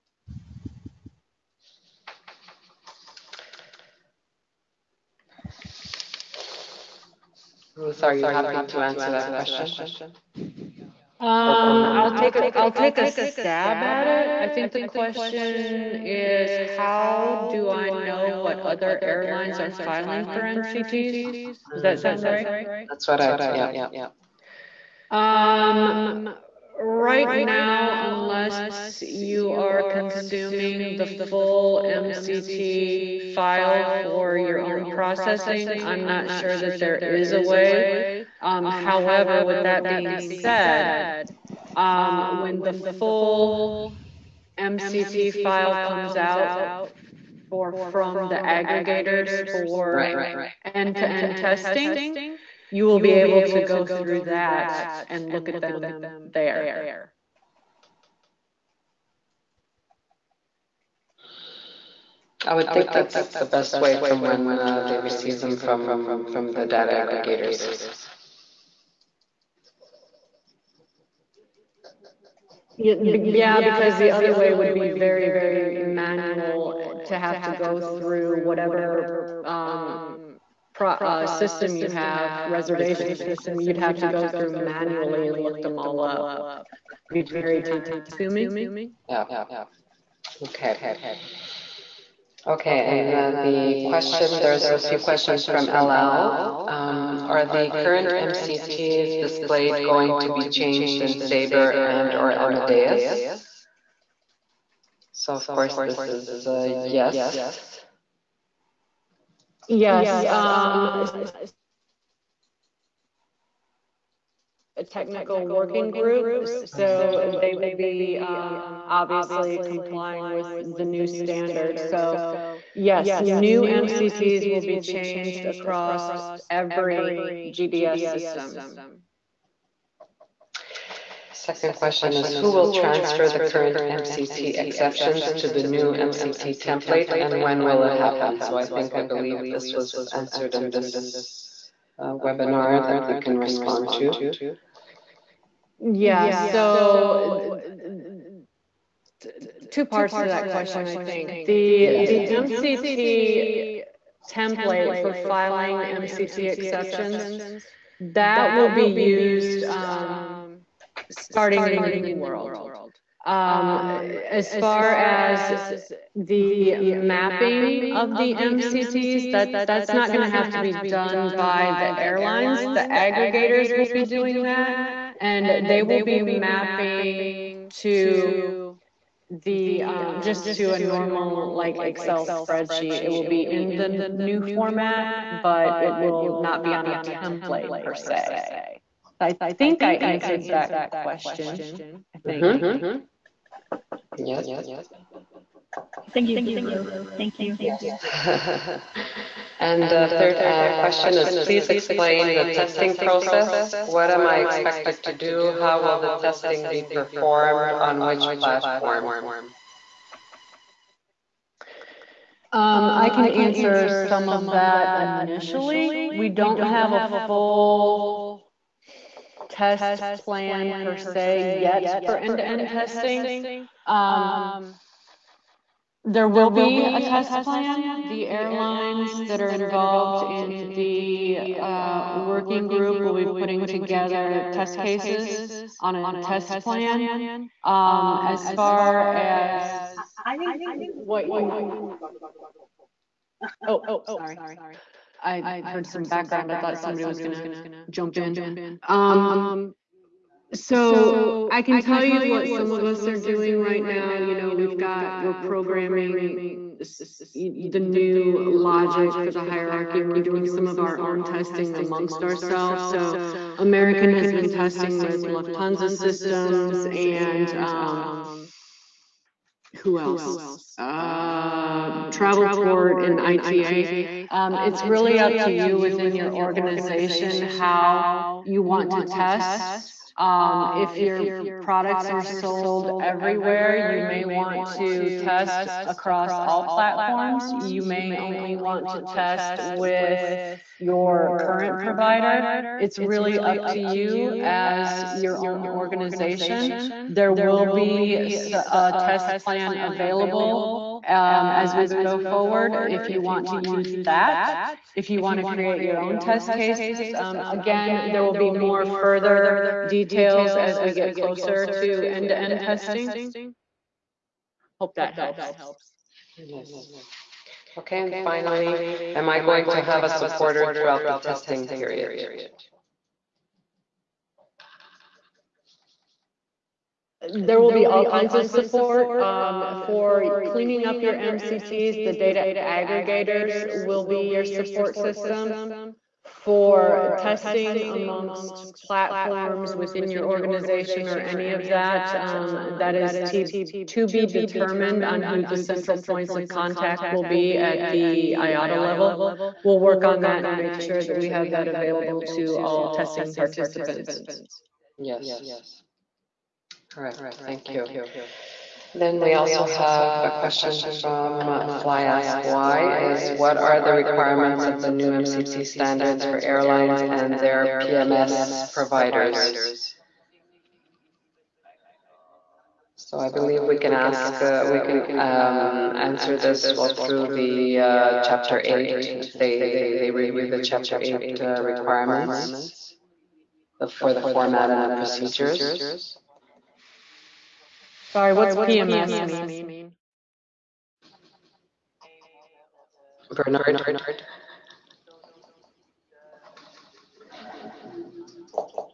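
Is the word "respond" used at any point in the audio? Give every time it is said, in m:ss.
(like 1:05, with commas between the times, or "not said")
2:23.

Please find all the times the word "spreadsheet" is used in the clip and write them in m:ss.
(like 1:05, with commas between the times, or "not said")
3:02.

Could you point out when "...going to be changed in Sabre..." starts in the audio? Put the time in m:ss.
1:39.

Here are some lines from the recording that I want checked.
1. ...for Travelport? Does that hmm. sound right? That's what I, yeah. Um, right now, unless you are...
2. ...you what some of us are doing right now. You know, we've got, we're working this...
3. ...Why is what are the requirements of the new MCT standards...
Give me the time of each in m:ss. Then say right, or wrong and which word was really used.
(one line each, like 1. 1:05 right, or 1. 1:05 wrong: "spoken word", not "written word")
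1. 0:20 wrong: "MCTs", not "Travelport"
2. 4:12 wrong: "programming", not "working"
3. 6:02 right.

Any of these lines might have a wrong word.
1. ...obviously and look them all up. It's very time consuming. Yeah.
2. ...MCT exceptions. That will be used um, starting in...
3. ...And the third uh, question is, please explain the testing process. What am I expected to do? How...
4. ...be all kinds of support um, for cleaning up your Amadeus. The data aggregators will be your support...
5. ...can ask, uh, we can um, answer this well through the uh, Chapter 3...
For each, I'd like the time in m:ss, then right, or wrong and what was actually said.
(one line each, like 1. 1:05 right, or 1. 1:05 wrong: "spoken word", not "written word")
1. 1:24 wrong: "manually", not "obviously"
2. 2:35 right
3. 3:19 right
4. 5:27 wrong: "MCTs", not "Amadeus"
5. 6:13 wrong: "8", not "3".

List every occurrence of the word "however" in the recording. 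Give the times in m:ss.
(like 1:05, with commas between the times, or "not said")
0:38.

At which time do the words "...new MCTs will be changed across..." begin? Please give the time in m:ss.
2:03.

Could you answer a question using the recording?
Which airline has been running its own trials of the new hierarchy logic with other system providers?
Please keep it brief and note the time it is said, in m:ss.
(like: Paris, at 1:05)
American, at 4:23.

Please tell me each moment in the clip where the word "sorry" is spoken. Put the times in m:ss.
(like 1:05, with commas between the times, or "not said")
4:04, 6:28.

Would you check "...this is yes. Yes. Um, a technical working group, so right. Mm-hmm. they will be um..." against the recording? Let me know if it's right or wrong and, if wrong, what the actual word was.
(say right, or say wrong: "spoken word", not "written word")
right.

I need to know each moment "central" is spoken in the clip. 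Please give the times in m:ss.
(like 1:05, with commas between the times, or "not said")
5:45.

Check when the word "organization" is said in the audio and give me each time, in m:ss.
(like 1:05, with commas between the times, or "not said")
4:36, 4:55, 5:40.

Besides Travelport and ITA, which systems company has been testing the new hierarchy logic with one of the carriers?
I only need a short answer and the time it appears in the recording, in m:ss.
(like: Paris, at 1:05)
Lufthansa Systems, at 4:25.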